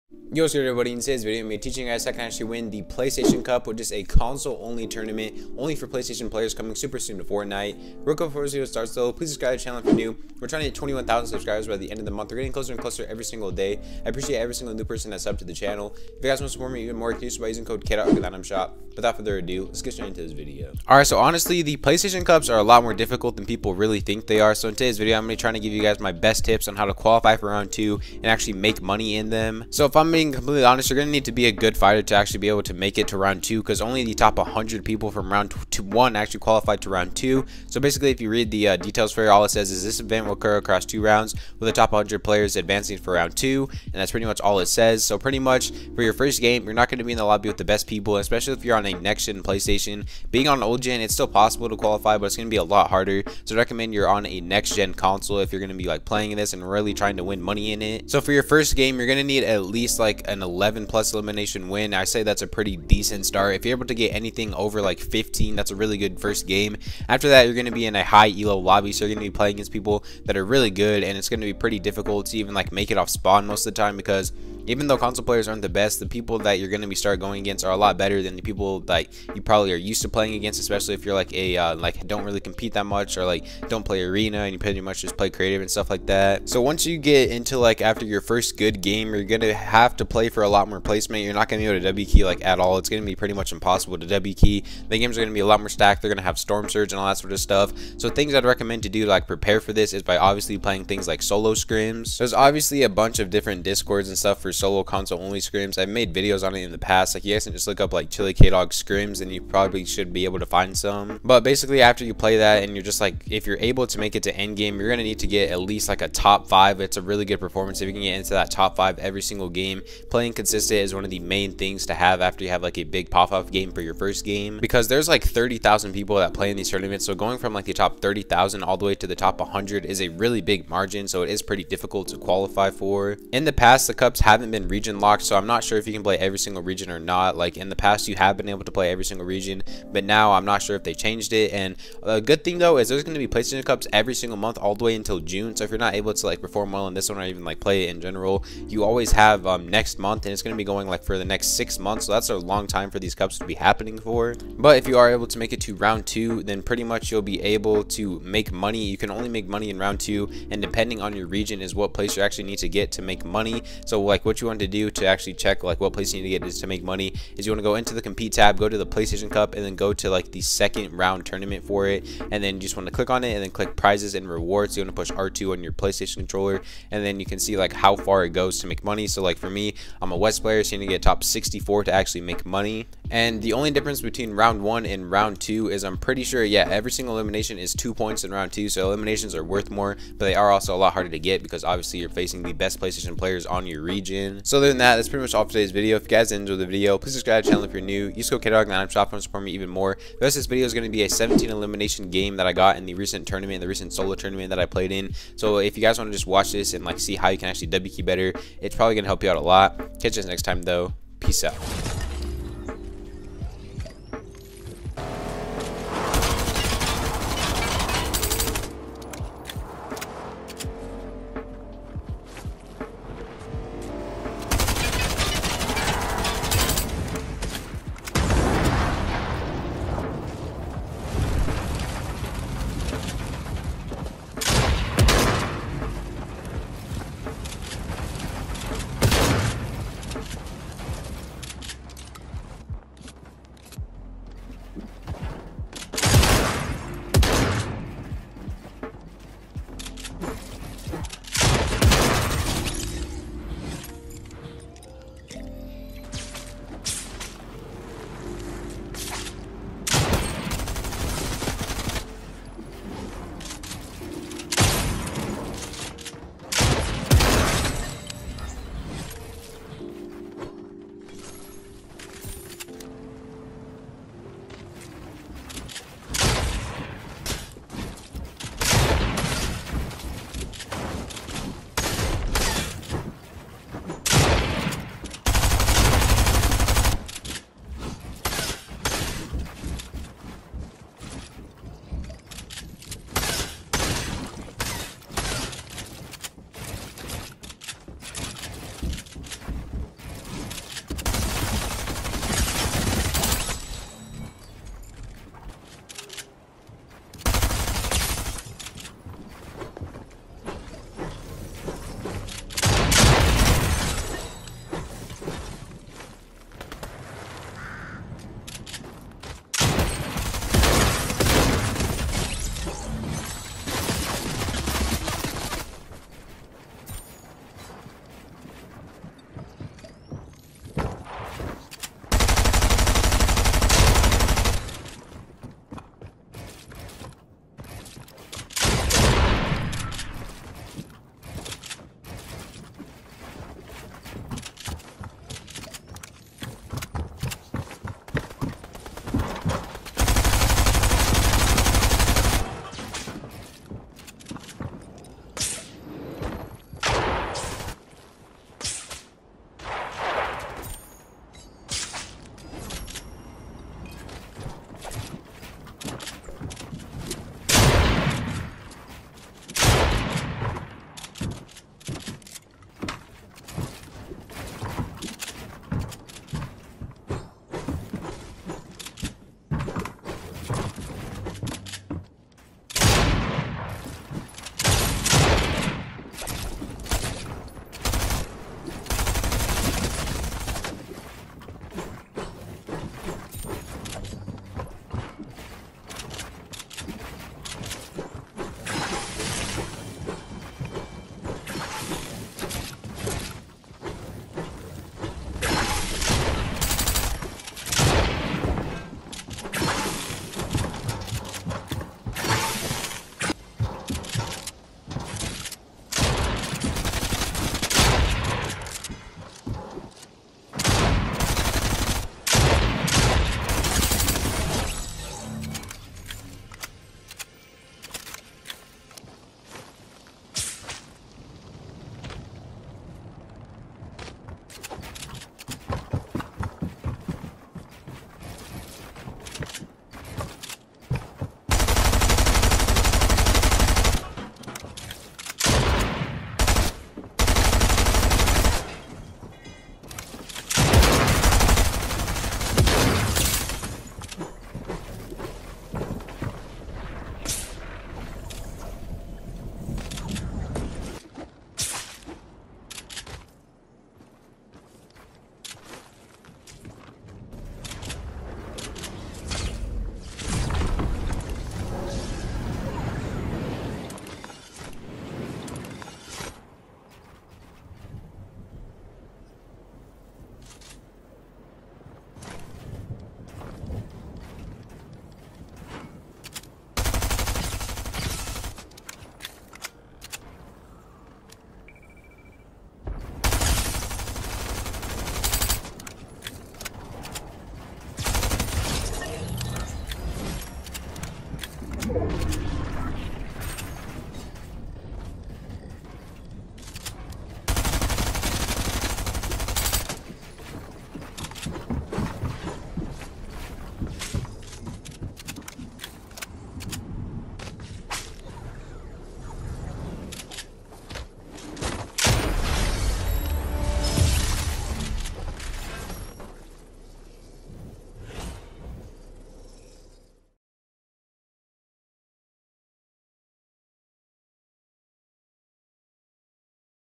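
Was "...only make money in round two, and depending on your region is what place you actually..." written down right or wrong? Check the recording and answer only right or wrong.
right.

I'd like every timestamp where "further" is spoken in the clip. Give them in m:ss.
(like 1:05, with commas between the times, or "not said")
0:19.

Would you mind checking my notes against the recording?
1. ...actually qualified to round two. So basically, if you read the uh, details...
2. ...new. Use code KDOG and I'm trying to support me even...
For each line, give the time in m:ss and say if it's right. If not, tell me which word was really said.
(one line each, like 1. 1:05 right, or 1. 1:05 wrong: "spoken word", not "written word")
1. 0:36 right
2. 3:17 wrong: "shopping", not "trying".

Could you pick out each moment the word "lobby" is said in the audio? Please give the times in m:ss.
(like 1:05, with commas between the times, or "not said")
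0:47, 1:08.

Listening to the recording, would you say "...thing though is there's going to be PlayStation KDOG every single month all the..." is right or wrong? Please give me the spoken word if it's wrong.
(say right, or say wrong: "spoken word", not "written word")
wrong: "Cups", not "KDOG".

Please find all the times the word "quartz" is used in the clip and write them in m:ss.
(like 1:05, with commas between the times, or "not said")
not said.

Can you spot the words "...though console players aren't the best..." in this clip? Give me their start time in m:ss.
1:14.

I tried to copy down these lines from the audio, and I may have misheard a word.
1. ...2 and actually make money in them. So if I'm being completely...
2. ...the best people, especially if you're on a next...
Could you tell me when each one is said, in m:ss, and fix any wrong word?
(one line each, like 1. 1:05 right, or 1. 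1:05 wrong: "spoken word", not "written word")
1. 0:27 right
2. 0:47 right.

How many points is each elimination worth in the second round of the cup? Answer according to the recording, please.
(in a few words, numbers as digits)
2.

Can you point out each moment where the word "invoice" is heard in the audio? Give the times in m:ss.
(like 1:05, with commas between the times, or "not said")
not said.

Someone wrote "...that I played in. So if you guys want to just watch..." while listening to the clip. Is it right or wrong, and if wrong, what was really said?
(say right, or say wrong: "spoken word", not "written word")
right.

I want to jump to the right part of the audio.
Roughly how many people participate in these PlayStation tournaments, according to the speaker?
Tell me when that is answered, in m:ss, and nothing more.
2:05.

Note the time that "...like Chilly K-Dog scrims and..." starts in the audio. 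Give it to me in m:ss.
1:47.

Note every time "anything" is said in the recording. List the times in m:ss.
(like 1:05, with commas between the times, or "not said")
1:04.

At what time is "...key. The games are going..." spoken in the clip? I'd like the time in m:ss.
1:34.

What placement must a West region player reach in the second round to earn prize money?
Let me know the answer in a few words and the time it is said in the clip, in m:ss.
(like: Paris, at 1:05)
Top 64, at 3:01.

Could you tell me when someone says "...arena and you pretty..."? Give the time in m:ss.
1:24.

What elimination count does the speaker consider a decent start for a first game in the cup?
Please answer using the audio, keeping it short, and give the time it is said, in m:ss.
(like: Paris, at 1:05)
11, at 1:00.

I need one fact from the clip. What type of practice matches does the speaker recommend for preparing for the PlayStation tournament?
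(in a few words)
Solo scrims.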